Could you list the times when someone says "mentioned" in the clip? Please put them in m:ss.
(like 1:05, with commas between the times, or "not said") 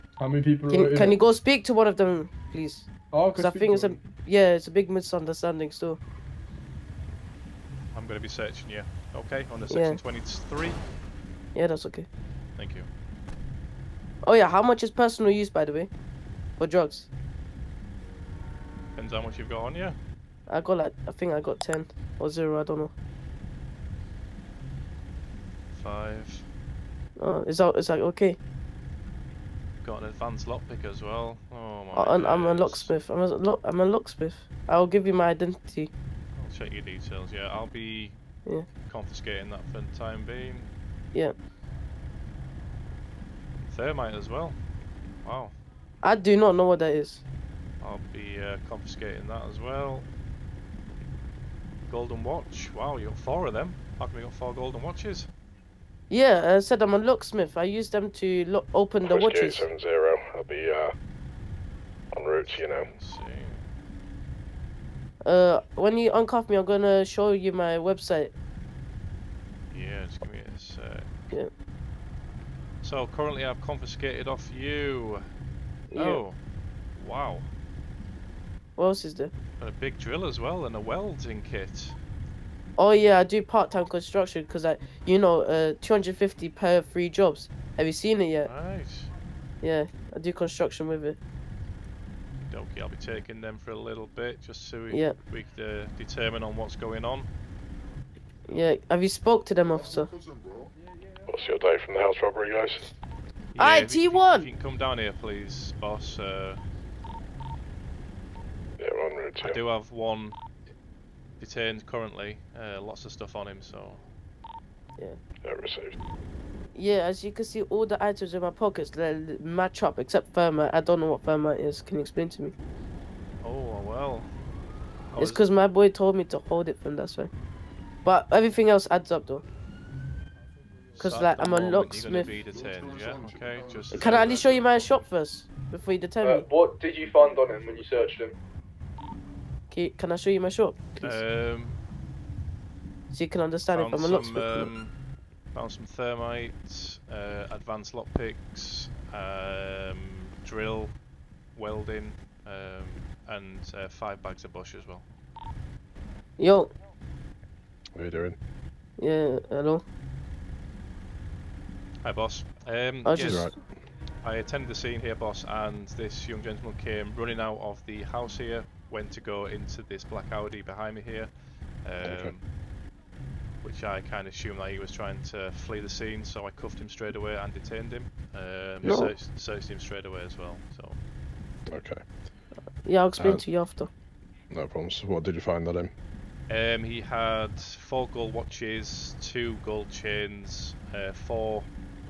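not said.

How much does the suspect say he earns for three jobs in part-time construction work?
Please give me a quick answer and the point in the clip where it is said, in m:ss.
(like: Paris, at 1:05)
250, at 1:25.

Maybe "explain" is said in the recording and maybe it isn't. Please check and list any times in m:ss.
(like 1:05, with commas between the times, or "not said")
2:02, 3:03.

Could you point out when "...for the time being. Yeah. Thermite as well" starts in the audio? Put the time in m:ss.
0:39.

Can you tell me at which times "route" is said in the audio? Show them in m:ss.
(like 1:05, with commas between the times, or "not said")
1:02, 1:49.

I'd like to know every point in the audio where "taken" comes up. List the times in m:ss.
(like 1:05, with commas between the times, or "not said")
not said.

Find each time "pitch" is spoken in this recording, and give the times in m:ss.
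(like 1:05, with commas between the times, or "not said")
not said.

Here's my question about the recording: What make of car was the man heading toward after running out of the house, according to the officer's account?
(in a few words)
Audi.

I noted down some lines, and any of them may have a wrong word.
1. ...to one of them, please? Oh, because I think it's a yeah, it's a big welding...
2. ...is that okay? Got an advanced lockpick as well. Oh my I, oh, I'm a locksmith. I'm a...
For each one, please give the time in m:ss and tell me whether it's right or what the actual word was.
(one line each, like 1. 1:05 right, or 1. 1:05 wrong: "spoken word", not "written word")
1. 0:01 wrong: "misunderstanding", not "welding"
2. 0:27 right.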